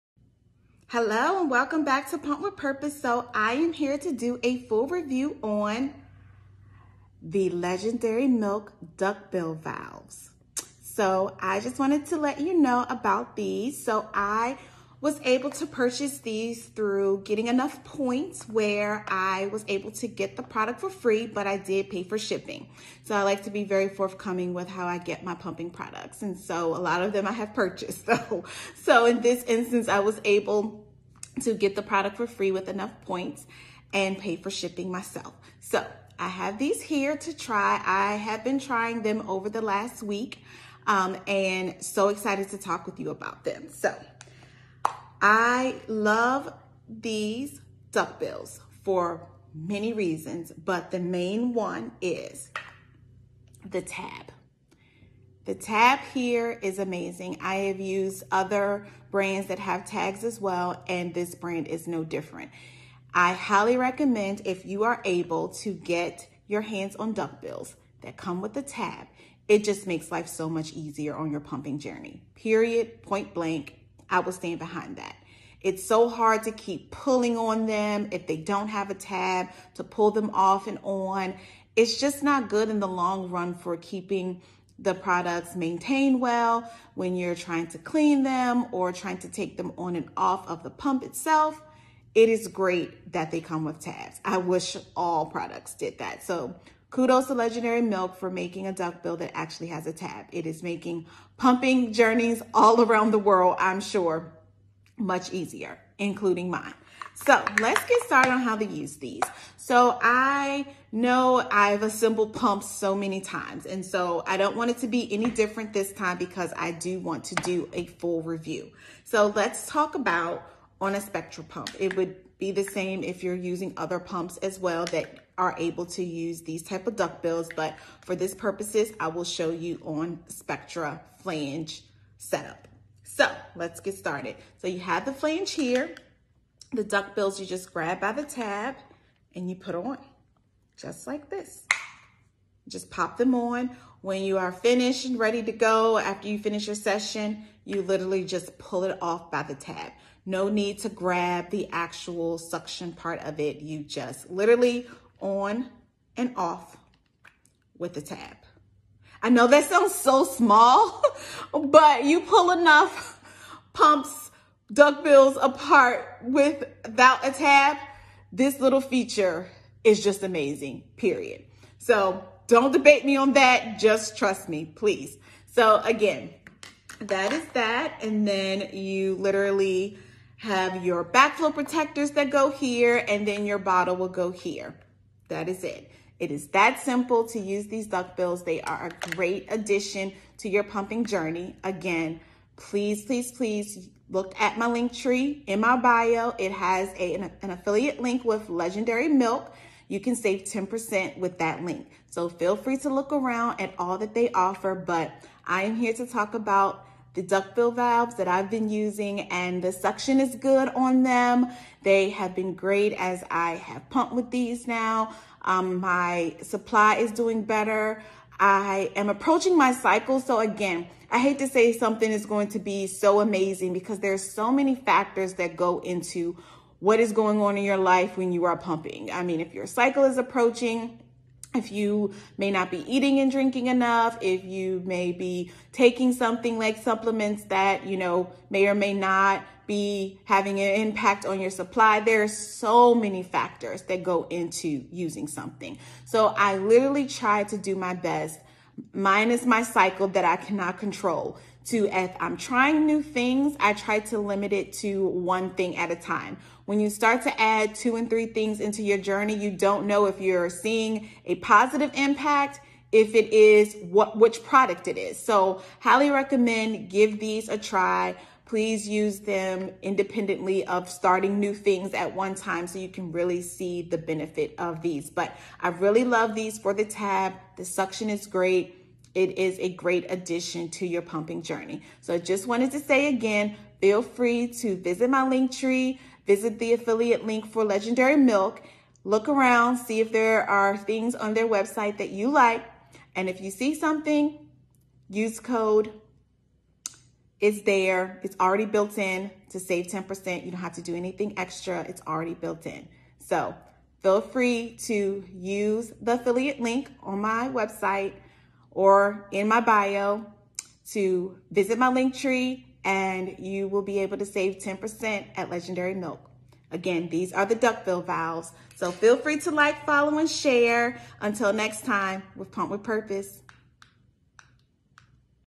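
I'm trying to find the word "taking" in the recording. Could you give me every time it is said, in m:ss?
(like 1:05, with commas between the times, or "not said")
3:55.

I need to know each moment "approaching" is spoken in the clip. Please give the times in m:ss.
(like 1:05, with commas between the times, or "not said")
3:39, 3:50.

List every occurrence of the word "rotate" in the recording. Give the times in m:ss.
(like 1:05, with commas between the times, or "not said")
not said.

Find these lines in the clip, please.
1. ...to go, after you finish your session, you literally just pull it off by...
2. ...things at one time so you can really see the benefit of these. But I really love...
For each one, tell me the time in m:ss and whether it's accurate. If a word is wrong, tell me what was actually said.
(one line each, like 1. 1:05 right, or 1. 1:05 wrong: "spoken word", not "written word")
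1. 2:25 right
2. 4:31 right.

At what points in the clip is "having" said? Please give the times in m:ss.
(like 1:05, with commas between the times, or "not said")
4:00.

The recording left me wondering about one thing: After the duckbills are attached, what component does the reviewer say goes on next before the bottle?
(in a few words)
Backflow protectors.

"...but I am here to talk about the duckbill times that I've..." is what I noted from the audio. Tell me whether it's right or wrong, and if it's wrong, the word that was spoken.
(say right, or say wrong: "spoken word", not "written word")
wrong: "valves", not "times".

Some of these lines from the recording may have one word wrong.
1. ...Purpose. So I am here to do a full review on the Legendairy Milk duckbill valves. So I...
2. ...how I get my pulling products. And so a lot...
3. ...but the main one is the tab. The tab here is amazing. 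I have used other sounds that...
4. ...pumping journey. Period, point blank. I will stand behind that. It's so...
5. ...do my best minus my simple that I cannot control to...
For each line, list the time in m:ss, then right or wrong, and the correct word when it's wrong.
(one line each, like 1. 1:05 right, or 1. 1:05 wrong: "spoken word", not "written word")
1. 0:02 right
2. 0:24 wrong: "pumping", not "pulling"
3. 0:50 wrong: "brands", not "sounds"
4. 1:11 right
5. 4:07 wrong: "cycle", not "simple".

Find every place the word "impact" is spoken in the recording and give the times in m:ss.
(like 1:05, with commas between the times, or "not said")
4:00, 4:21.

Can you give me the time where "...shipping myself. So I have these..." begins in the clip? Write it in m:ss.
0:34.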